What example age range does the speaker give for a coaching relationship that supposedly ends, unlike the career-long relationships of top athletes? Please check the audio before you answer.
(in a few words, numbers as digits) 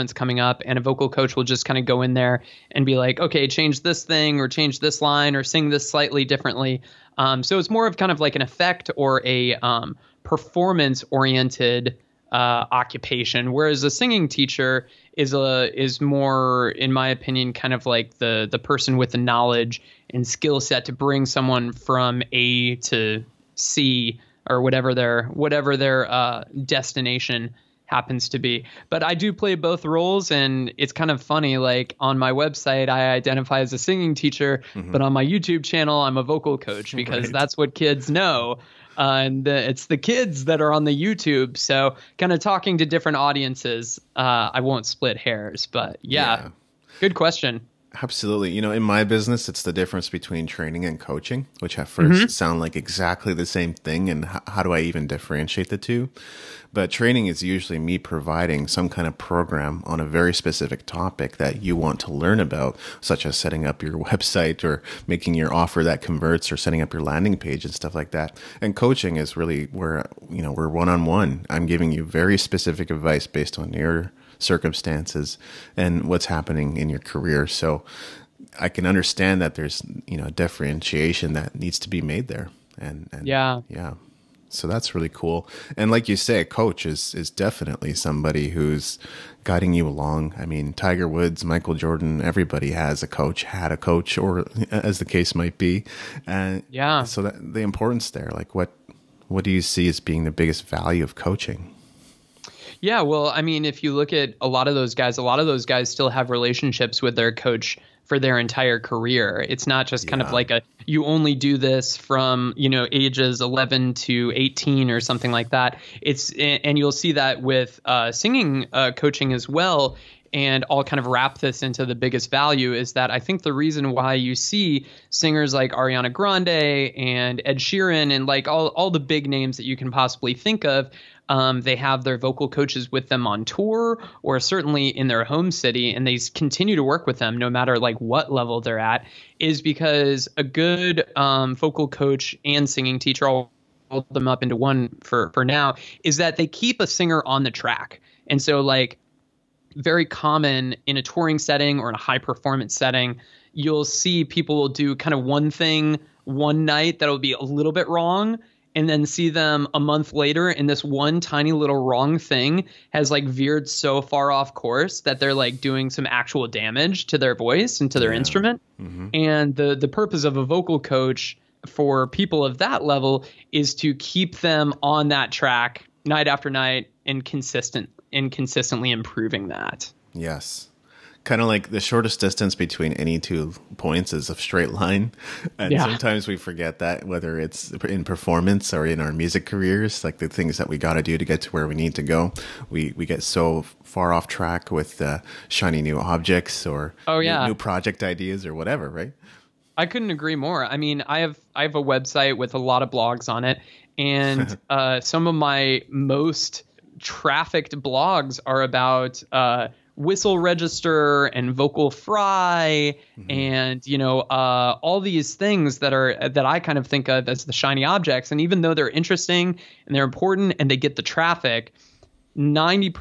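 11 to 18.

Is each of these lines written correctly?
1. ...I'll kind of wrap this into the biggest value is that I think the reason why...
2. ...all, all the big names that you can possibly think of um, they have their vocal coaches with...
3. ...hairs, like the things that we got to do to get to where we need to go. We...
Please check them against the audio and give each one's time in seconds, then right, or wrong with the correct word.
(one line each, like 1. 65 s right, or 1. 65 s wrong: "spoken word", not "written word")
1. 120 s right
2. 128 s right
3. 189 s wrong: "careers", not "hairs".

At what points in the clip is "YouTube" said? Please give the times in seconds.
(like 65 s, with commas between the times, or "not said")
35 s, 41 s.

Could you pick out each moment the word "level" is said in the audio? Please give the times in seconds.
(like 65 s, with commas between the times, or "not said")
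138 s, 172 s.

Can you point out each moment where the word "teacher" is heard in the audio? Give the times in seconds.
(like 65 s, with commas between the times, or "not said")
14 s, 34 s, 142 s.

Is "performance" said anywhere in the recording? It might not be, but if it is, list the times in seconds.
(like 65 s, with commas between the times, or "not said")
10 s, 152 s, 188 s.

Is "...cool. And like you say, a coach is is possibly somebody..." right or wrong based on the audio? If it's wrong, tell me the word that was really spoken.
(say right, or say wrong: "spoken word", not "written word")
wrong: "definitely", not "possibly".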